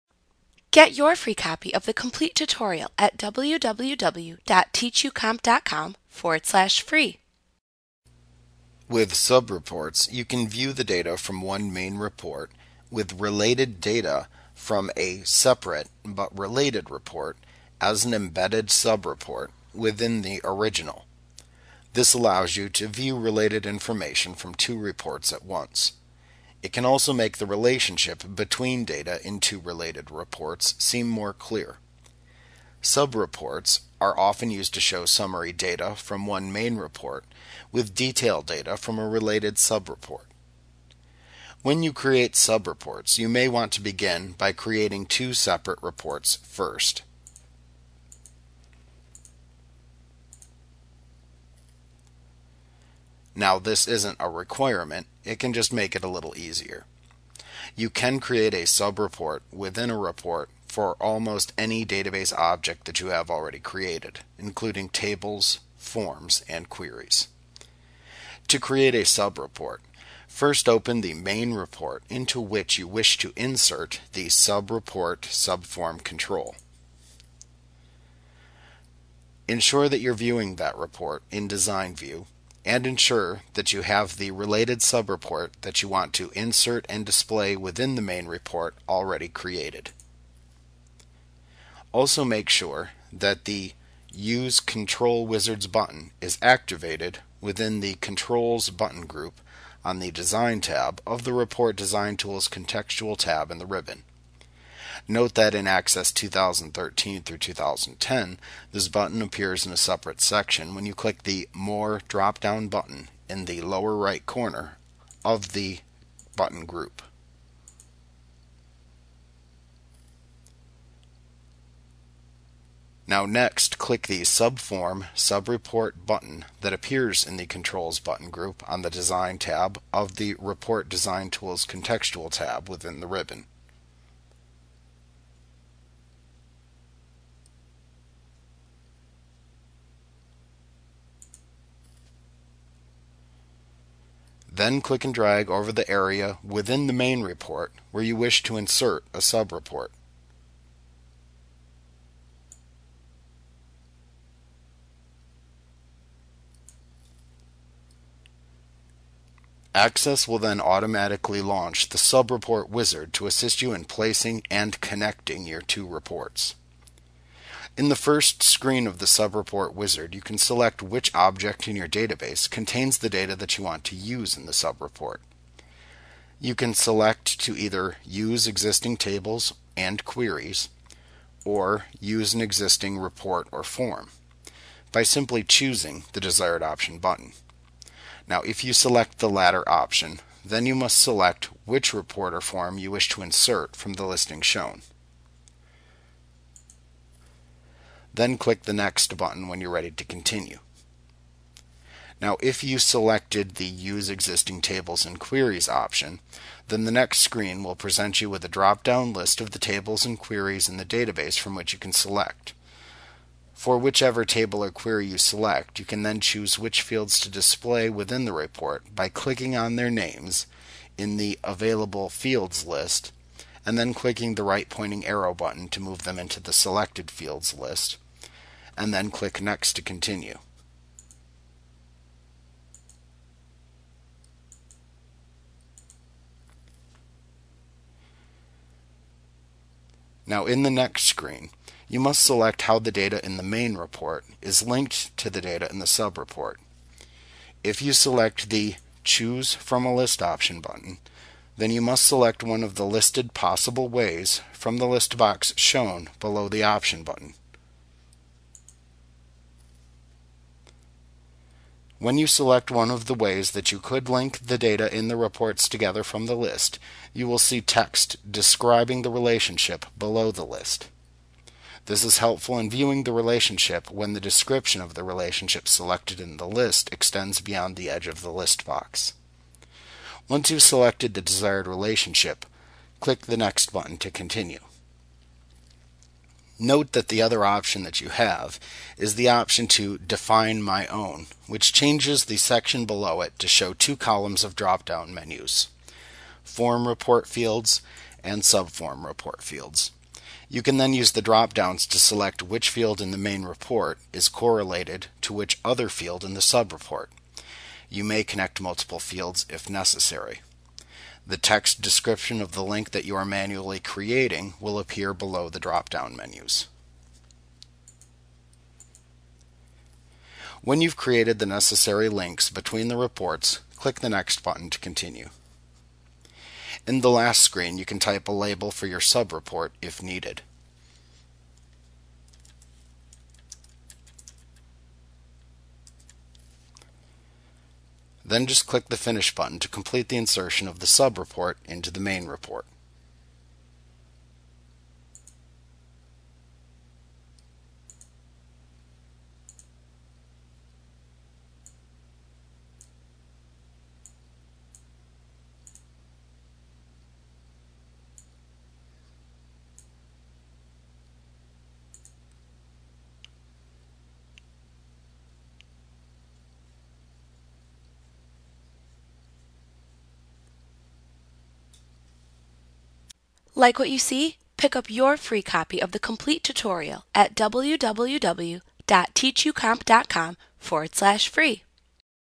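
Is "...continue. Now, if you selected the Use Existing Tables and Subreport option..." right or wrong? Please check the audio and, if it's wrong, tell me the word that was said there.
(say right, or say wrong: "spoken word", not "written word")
wrong: "Queries", not "Subreport".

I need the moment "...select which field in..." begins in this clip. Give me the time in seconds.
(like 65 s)
301 s.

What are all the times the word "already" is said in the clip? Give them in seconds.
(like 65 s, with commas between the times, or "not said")
63 s, 88 s.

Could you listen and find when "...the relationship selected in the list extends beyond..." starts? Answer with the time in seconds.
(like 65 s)
274 s.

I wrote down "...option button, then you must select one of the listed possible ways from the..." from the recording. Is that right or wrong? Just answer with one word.
right.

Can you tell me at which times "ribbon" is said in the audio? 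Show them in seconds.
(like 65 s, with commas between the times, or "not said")
103 s, 133 s.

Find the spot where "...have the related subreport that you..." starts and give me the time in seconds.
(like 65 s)
83 s.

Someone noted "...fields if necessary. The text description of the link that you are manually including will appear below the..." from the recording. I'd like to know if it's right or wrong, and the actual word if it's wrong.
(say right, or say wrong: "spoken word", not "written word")
wrong: "creating", not "including".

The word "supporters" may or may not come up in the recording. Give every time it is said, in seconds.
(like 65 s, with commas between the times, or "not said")
not said.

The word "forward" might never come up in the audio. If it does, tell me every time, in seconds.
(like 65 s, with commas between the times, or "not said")
6 s, 380 s.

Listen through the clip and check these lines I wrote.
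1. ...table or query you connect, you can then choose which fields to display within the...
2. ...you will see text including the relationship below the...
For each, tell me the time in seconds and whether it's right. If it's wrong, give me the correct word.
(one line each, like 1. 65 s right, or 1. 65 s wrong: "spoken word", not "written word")
1. 214 s wrong: "select", not "connect"
2. 267 s wrong: "describing", not "including".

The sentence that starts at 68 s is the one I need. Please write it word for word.
To create a subreport, first open the main report into which you wish to insert the subreport subform control.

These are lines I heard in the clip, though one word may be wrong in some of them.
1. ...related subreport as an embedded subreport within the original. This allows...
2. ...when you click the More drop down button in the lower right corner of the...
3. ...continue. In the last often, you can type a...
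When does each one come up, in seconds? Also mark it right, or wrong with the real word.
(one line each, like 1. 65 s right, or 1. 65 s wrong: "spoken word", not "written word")
1. 16 s wrong: "report", not "subreport"
2. 110 s right
3. 324 s wrong: "screen", not "often".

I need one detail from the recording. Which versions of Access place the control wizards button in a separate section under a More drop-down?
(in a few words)
Access 2013 through 2010.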